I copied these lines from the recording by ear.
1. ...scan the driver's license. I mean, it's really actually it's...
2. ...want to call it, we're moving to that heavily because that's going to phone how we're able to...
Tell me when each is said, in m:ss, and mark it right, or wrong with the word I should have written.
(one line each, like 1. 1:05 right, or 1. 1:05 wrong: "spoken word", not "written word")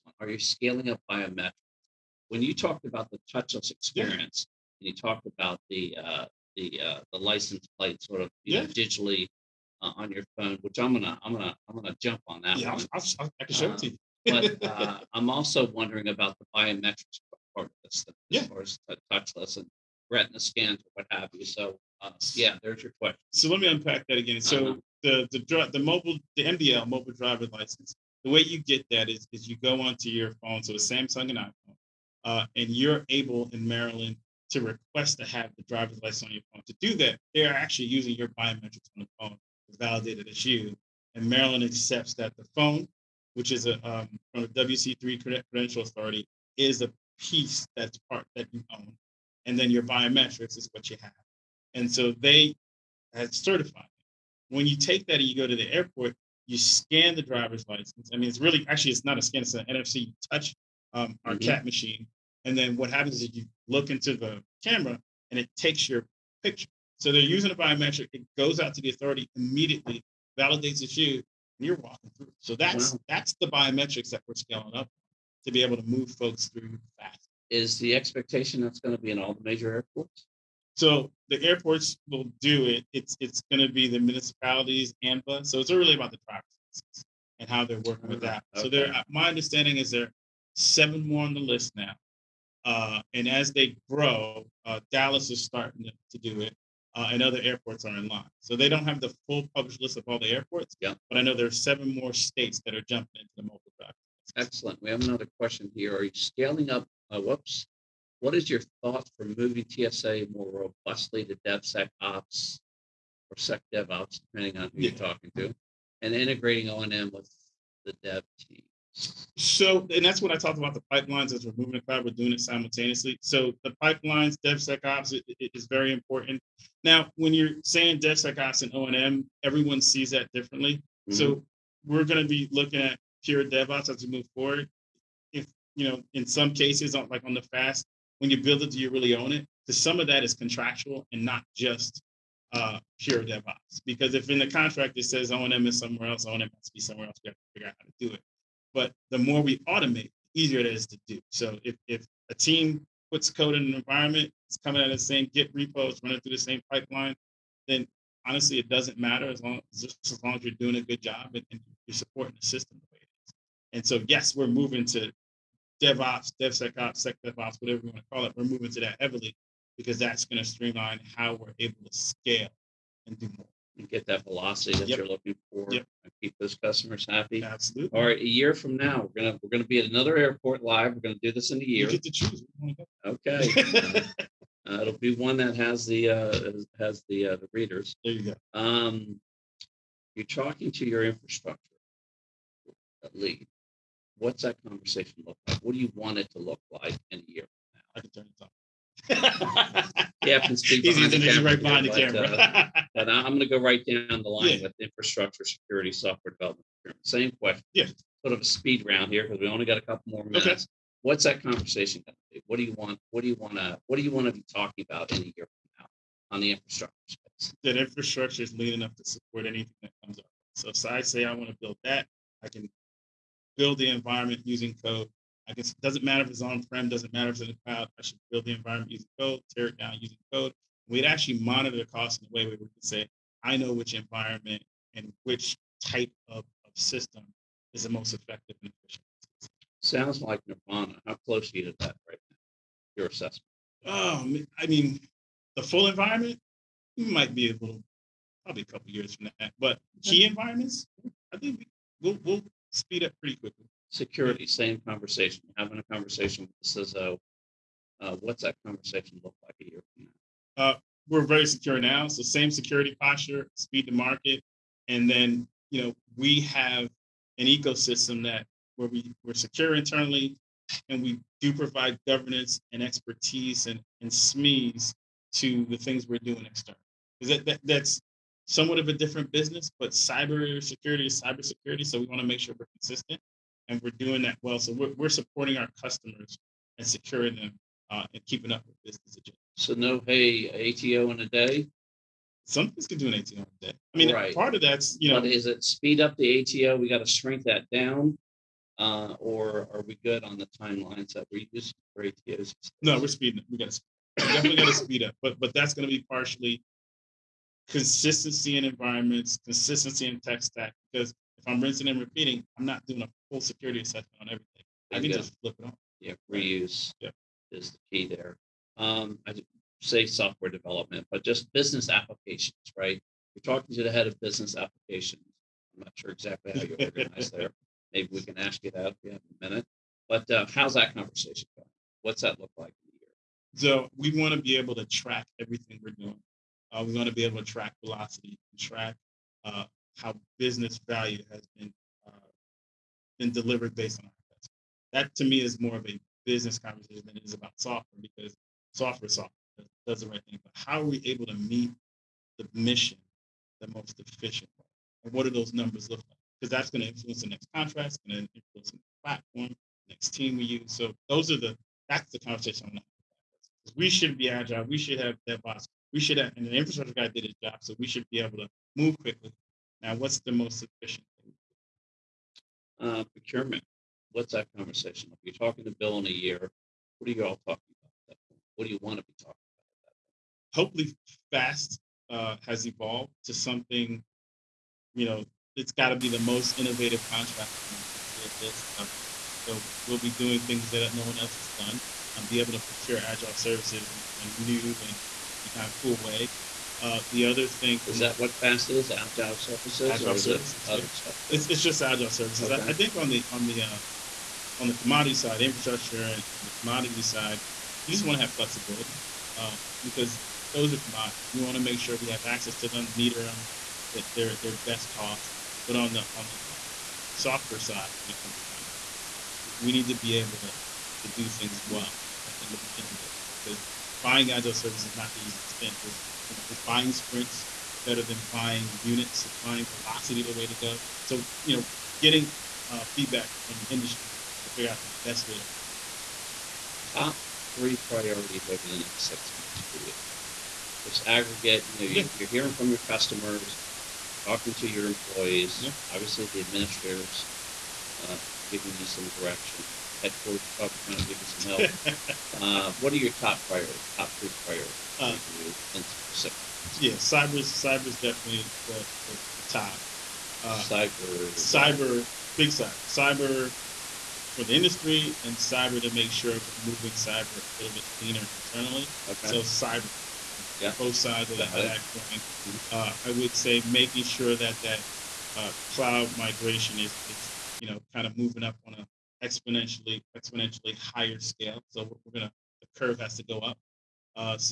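1. 0:56 right
2. 2:47 wrong: "streamline", not "phone".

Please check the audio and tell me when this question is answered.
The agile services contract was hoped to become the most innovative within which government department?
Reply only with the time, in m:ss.
6:28.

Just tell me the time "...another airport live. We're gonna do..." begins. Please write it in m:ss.
2:59.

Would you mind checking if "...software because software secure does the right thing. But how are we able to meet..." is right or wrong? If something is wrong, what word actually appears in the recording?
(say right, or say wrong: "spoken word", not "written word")
wrong: "software", not "secure".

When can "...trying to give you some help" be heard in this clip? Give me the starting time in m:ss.
7:30.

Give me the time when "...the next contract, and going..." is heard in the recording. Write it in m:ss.
5:57.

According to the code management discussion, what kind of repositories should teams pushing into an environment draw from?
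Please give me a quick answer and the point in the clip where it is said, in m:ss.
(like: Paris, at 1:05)
Git repos, at 2:35.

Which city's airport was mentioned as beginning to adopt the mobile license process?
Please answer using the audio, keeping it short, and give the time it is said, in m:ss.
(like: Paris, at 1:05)
Dallas, at 1:34.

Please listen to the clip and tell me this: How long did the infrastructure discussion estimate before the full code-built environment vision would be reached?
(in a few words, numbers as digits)
a couple years.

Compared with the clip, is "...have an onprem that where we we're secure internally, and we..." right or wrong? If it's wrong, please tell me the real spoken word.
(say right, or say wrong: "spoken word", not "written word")
wrong: "ecosystem", not "onprem".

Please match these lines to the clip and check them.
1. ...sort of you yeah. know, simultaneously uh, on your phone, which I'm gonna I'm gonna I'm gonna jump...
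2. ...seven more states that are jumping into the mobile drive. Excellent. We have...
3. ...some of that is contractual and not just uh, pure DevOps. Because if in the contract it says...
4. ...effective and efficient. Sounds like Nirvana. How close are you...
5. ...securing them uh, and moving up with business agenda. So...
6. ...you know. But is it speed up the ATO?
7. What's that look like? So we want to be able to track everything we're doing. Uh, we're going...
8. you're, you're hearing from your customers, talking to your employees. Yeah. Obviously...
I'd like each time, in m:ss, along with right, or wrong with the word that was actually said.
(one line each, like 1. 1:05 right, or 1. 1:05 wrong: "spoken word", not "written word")
1. 0:08 wrong: "digitally", not "simultaneously"
2. 1:41 right
3. 2:19 right
4. 3:58 right
5. 4:46 wrong: "keeping", not "moving"
6. 4:54 right
7. 5:32 right
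8. 7:22 right.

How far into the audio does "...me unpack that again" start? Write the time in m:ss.
0:23.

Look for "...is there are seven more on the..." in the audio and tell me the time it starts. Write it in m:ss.
1:29.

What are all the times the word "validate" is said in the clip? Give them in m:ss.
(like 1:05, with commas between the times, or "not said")
0:39, 1:10.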